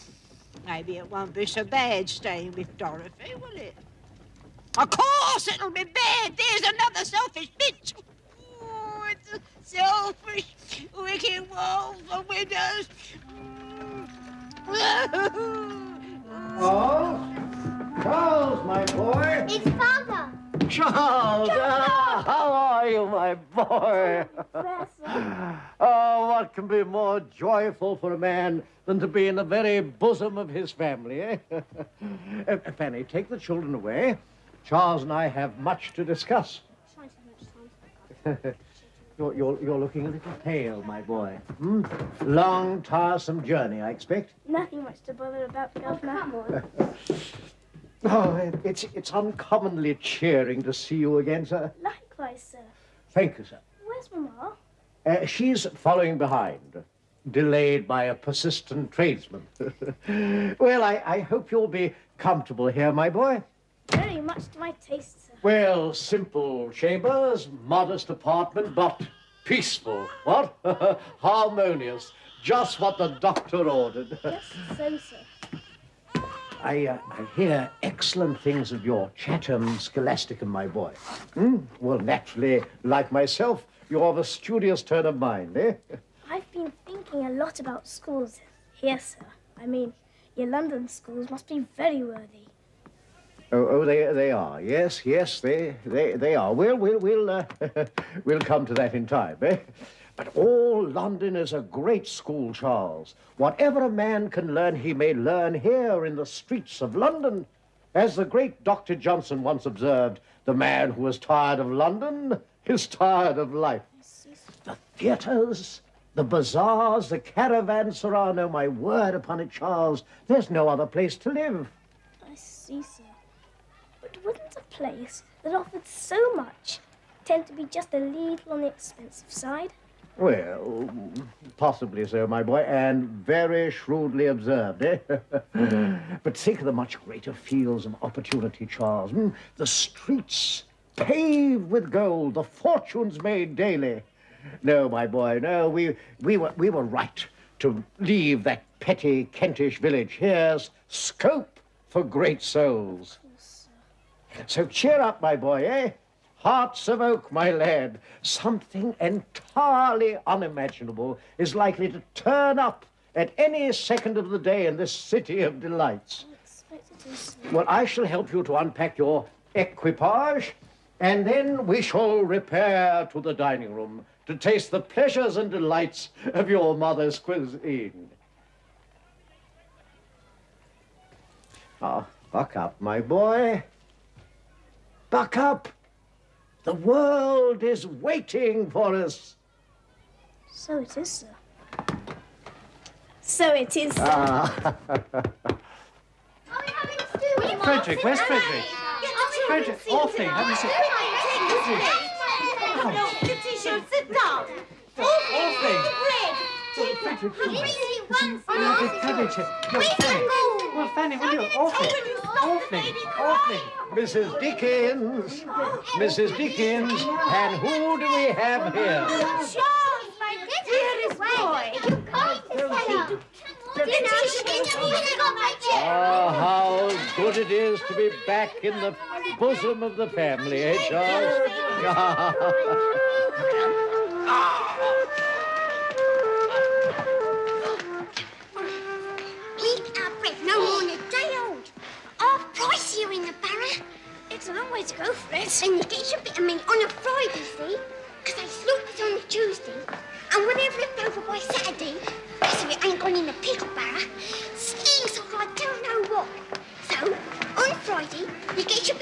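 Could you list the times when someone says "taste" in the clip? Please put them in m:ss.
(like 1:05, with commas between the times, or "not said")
1:04, 2:54.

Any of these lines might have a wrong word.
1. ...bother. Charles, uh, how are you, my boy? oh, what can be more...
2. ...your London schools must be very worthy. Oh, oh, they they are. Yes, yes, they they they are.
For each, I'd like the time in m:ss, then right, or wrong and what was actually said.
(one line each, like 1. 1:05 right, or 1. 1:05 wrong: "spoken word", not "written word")
1. 0:19 wrong: "father", not "bother"
2. 1:30 right.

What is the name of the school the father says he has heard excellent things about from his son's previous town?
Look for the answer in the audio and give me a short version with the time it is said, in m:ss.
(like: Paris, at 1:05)
Chatham Scholasticum, at 1:19.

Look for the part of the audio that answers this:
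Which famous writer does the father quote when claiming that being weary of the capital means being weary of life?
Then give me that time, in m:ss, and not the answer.
1:48.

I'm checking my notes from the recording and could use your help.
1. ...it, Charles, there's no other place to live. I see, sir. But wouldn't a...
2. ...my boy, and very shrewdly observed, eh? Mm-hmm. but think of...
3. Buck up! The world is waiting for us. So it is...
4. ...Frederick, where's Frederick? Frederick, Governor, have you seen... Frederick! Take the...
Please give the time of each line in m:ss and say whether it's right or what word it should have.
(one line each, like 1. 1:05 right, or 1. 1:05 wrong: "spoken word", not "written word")
1. 1:59 right
2. 2:12 right
3. 3:05 right
4. 3:16 wrong: "Orphy", not "Governor".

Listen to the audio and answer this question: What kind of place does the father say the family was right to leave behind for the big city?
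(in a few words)
Kentish village.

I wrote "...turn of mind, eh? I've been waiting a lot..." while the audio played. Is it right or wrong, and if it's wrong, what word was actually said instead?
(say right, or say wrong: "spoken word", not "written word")
wrong: "thinking", not "waiting".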